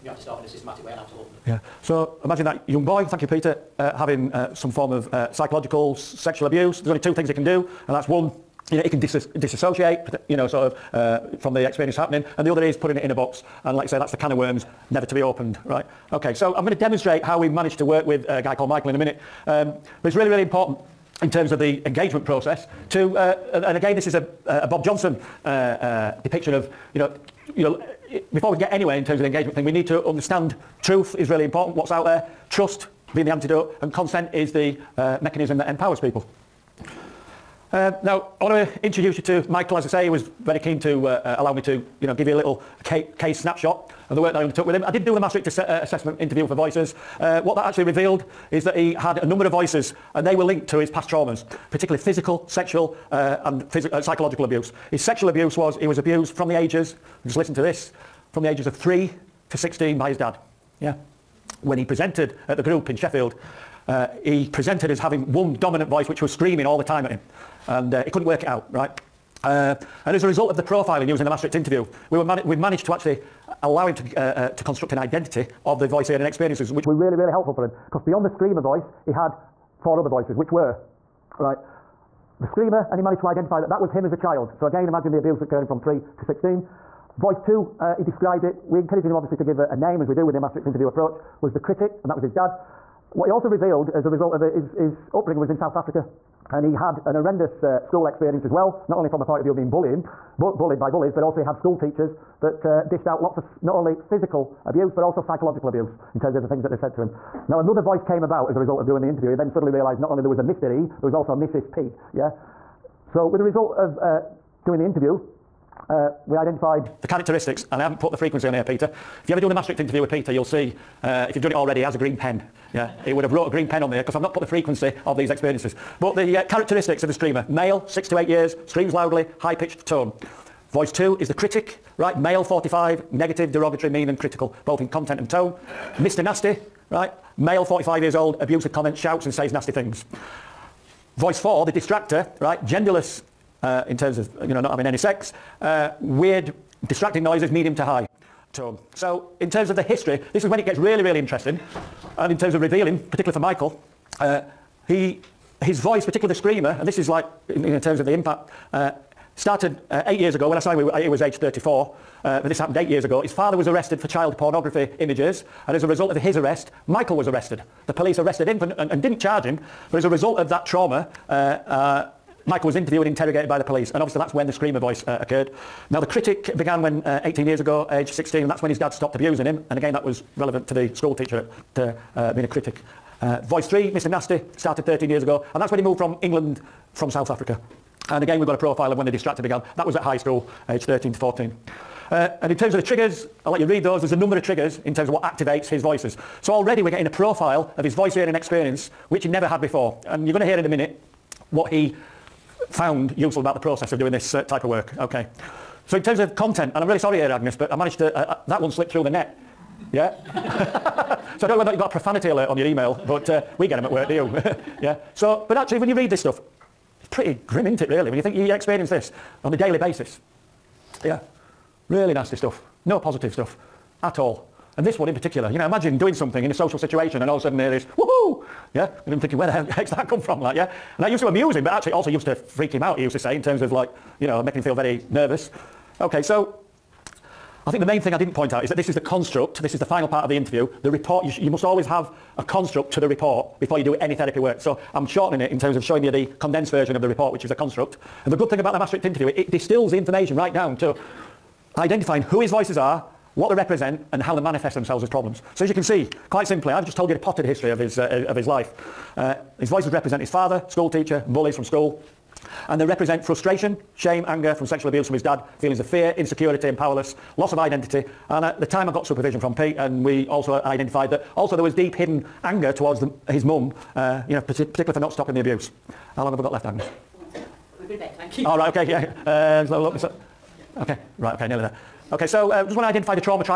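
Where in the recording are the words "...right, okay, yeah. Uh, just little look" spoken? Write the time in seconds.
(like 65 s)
278 s.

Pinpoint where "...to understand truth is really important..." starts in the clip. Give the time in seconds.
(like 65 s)
29 s.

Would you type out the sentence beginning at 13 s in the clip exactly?
And like I say, that's the can of worms, never to be opened, right?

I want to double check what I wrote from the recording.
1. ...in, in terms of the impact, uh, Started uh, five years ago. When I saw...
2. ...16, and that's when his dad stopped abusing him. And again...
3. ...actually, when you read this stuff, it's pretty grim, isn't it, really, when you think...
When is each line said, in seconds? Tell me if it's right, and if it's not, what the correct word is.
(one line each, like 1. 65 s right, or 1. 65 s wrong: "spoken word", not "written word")
1. 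157 s wrong: "eight", not "five"
2. 178 s right
3. 215 s right.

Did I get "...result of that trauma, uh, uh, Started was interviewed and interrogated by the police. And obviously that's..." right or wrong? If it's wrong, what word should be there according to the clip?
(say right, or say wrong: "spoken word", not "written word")
wrong: "Michael", not "Started".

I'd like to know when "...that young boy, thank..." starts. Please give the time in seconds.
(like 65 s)
2 s.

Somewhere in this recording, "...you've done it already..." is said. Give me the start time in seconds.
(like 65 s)
121 s.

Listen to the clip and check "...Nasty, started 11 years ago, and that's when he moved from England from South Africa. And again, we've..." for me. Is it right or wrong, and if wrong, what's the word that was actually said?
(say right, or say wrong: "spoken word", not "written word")
wrong: "13", not "11".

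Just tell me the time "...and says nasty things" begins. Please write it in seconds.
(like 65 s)
139 s.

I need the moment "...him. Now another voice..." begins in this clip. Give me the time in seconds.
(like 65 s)
107 s.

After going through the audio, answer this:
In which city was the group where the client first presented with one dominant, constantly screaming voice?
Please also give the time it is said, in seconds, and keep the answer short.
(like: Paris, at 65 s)
Sheffield, at 62 s.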